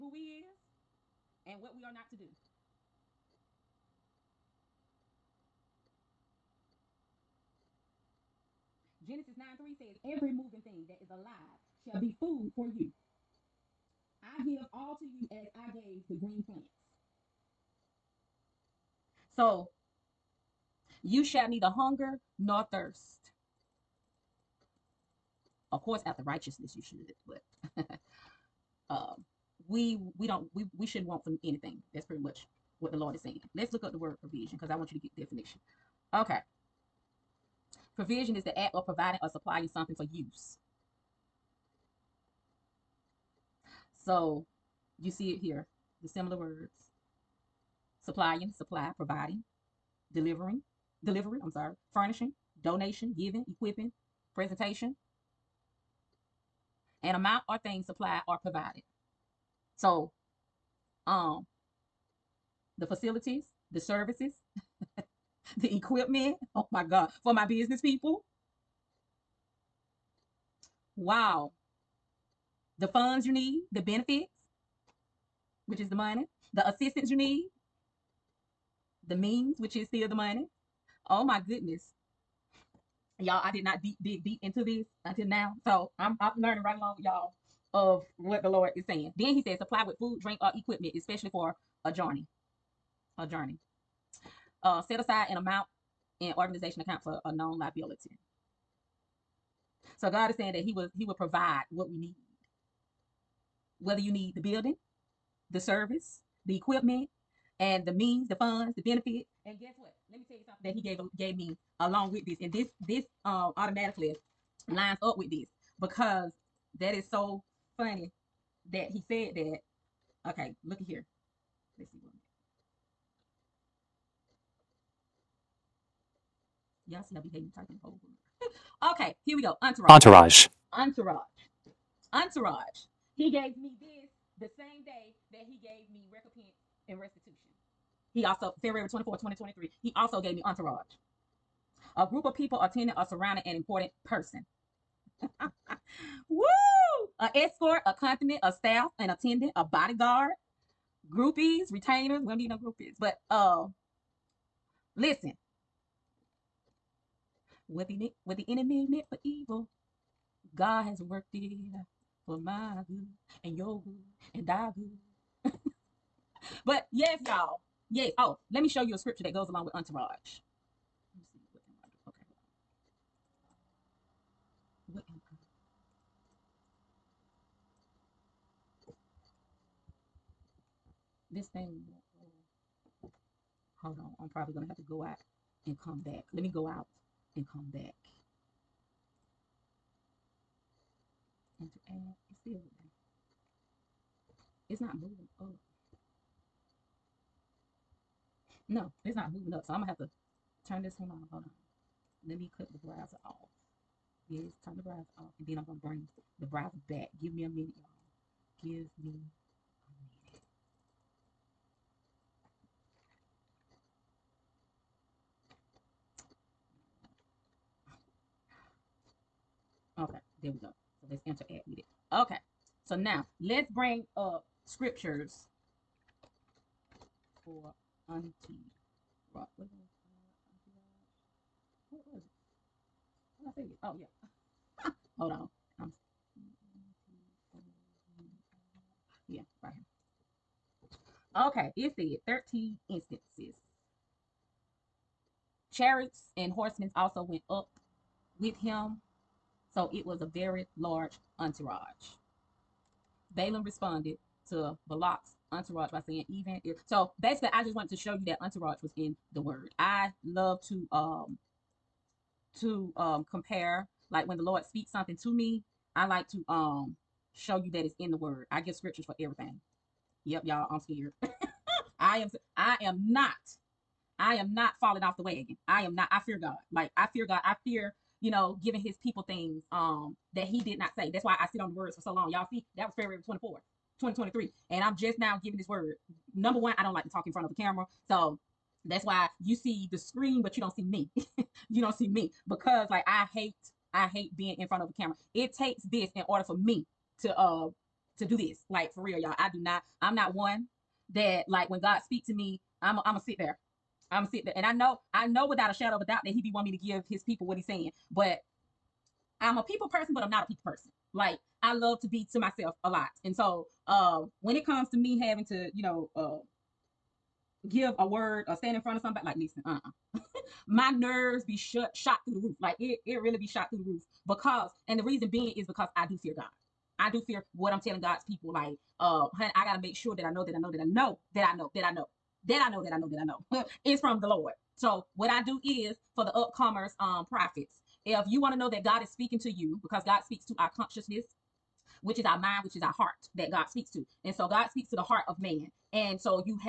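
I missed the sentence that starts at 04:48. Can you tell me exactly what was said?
So that's why you see the screen, but you don't see me.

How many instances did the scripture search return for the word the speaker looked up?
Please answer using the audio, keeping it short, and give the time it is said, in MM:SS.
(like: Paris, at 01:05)
13, at 04:02.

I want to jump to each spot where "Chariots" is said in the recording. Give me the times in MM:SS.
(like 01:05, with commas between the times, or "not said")
04:05.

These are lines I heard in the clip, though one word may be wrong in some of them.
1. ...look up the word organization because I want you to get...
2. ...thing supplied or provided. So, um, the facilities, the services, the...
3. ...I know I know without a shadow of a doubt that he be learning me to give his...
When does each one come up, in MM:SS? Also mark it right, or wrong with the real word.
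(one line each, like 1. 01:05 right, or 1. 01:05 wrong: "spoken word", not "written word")
1. 00:33 wrong: "provision", not "organization"
2. 00:57 right
3. 05:04 wrong: "wanting", not "learning".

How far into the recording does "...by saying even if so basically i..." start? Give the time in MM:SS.
04:15.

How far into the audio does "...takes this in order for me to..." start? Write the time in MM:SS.
04:55.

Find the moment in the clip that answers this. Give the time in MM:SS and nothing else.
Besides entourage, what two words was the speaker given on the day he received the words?
02:16.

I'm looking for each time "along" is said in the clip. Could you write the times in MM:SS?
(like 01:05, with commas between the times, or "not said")
01:26, 01:51, 02:49.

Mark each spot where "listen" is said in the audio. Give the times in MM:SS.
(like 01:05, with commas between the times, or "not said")
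02:34, 05:19.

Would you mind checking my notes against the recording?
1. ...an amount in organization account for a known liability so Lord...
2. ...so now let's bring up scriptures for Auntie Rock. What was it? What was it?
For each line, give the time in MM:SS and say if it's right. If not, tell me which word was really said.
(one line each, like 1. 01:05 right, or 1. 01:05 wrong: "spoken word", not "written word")
1. 01:35 wrong: "God", not "Lord"
2. 03:42 right.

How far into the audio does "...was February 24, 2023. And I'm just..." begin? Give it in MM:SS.
04:42.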